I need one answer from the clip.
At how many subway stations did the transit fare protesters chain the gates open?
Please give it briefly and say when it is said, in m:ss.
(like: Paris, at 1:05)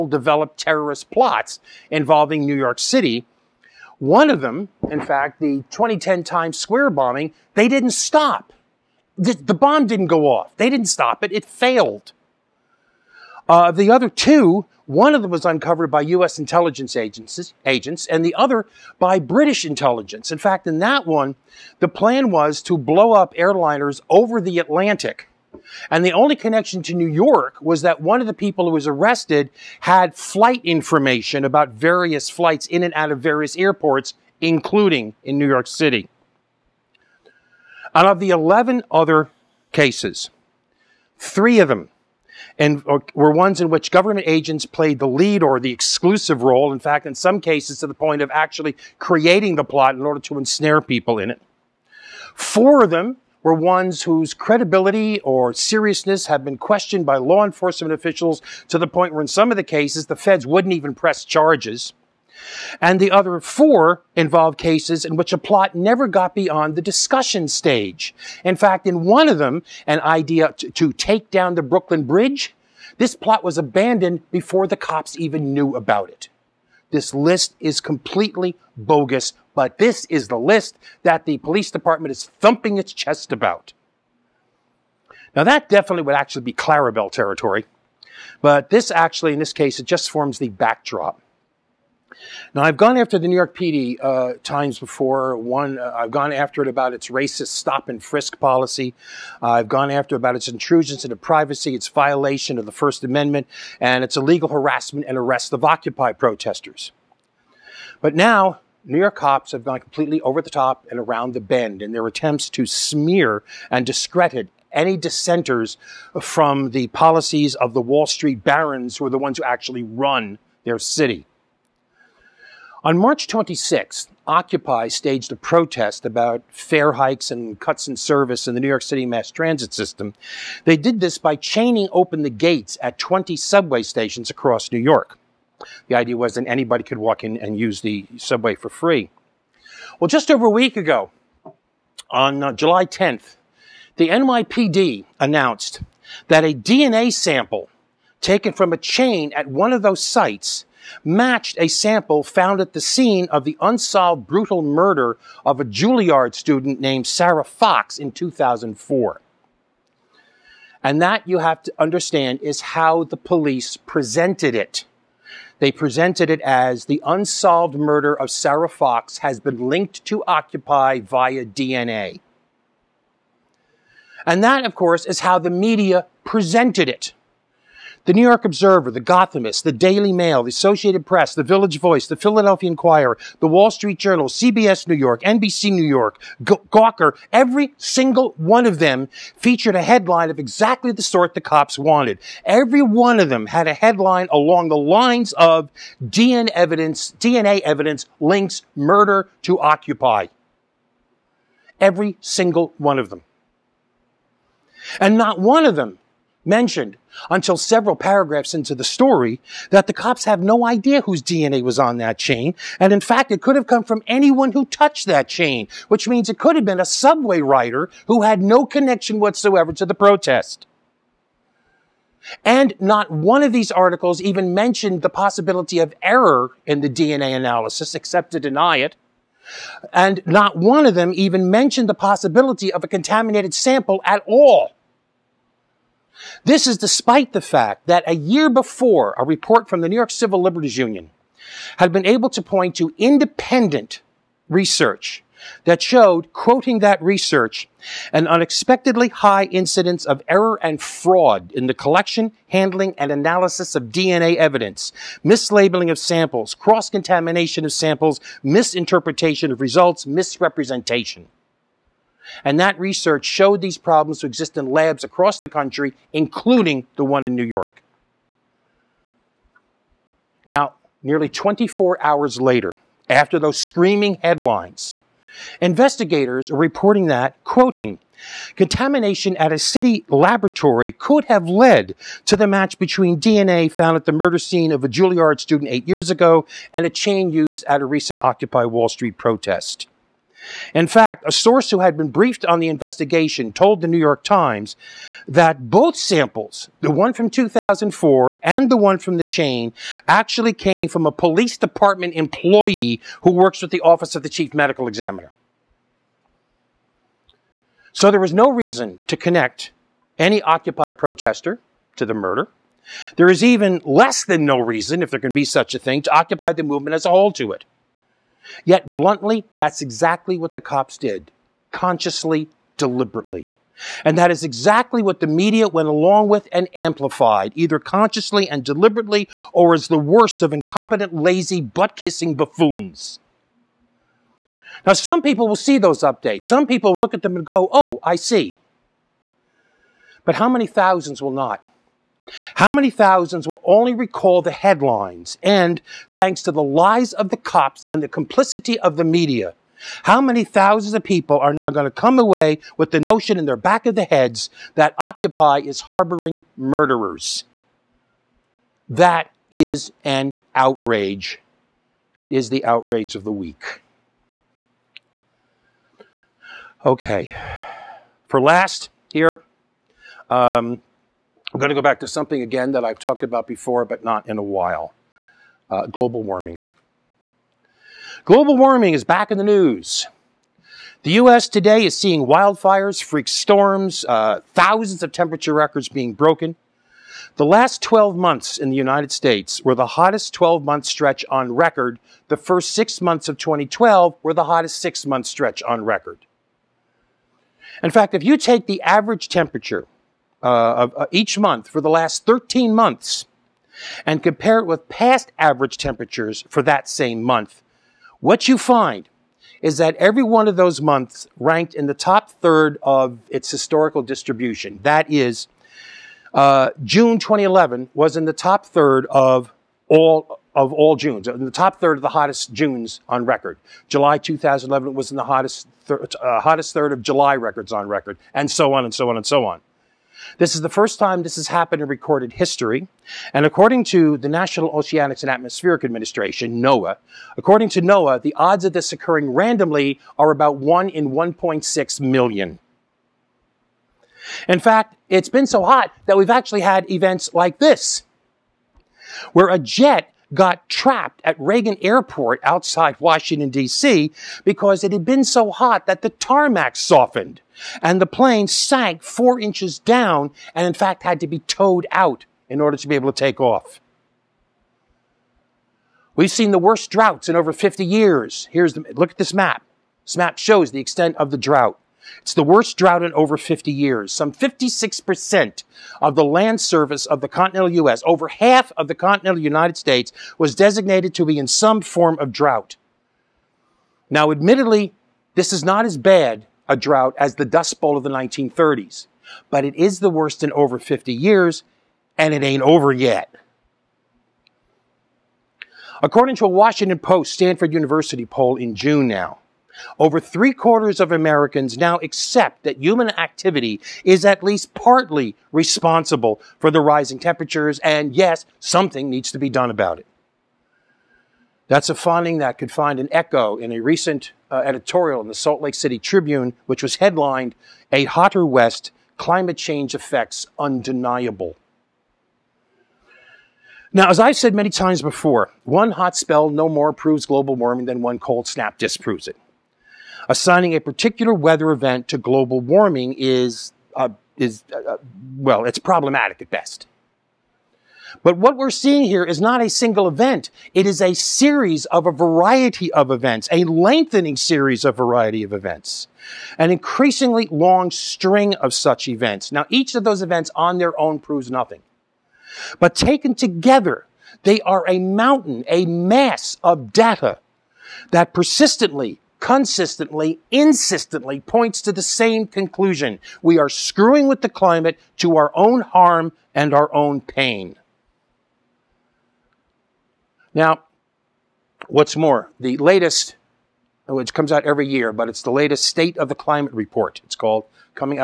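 20, at 2:12.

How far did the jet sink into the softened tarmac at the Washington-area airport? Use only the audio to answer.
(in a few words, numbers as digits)
4 inches.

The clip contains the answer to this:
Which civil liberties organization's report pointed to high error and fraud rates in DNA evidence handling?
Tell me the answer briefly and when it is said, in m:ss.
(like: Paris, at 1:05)
New York Civil Liberties Union, at 3:59.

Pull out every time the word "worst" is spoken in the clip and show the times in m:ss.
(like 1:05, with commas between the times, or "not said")
5:29, 7:46, 7:52, 8:10.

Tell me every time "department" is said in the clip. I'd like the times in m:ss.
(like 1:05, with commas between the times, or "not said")
1:21, 5:01.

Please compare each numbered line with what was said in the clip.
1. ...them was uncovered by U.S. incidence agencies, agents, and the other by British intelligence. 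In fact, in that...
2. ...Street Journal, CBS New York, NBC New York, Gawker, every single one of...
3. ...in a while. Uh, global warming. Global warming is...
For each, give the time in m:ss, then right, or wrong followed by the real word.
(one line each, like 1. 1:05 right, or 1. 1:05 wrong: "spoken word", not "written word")
1. 0:15 wrong: "intelligence", not "incidence"
2. 3:03 right
3. 6:14 right.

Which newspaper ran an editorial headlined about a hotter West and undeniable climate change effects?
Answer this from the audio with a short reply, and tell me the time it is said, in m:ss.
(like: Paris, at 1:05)
Salt Lake City Tribune, at 8:35.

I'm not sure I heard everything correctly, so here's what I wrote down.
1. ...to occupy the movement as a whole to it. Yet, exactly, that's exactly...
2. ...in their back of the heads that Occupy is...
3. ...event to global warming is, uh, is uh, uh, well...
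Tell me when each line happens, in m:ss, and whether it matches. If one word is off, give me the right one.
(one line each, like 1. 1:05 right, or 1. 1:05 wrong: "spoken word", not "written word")
1. 5:16 wrong: "bluntly", not "exactly"
2. 5:53 right
3. 8:51 right.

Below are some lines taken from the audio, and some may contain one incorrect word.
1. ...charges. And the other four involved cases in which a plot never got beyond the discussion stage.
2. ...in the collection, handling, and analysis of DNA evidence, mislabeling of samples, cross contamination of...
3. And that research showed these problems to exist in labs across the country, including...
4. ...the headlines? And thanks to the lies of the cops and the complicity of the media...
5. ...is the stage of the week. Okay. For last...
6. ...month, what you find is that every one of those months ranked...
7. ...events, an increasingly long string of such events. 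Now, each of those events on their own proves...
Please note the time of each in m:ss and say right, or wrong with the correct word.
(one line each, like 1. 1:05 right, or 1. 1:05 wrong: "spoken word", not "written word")
1. 1:01 right
2. 4:11 right
3. 4:22 right
4. 5:44 right
5. 6:02 wrong: "outrage", not "stage"
6. 6:47 right
7. 9:05 right.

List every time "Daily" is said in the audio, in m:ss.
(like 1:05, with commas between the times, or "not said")
2:59.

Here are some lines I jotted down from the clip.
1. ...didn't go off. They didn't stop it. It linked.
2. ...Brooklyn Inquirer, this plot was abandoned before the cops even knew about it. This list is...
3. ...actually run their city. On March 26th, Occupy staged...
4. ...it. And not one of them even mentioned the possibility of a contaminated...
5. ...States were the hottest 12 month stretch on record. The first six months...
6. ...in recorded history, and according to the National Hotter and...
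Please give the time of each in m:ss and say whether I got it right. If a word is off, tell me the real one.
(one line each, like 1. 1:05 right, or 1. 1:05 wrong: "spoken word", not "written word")
1. 0:09 wrong: "failed", not "linked"
2. 1:11 wrong: "Bridge", not "Inquirer"
3. 1:59 right
4. 3:48 right
5. 6:29 right
6. 7:11 wrong: "Oceanics", not "Hotter".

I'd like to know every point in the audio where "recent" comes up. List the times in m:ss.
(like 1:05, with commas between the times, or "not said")
4:47, 8:33.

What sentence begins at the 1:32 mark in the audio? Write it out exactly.
Now, I've gone after the New York PD uh, times before.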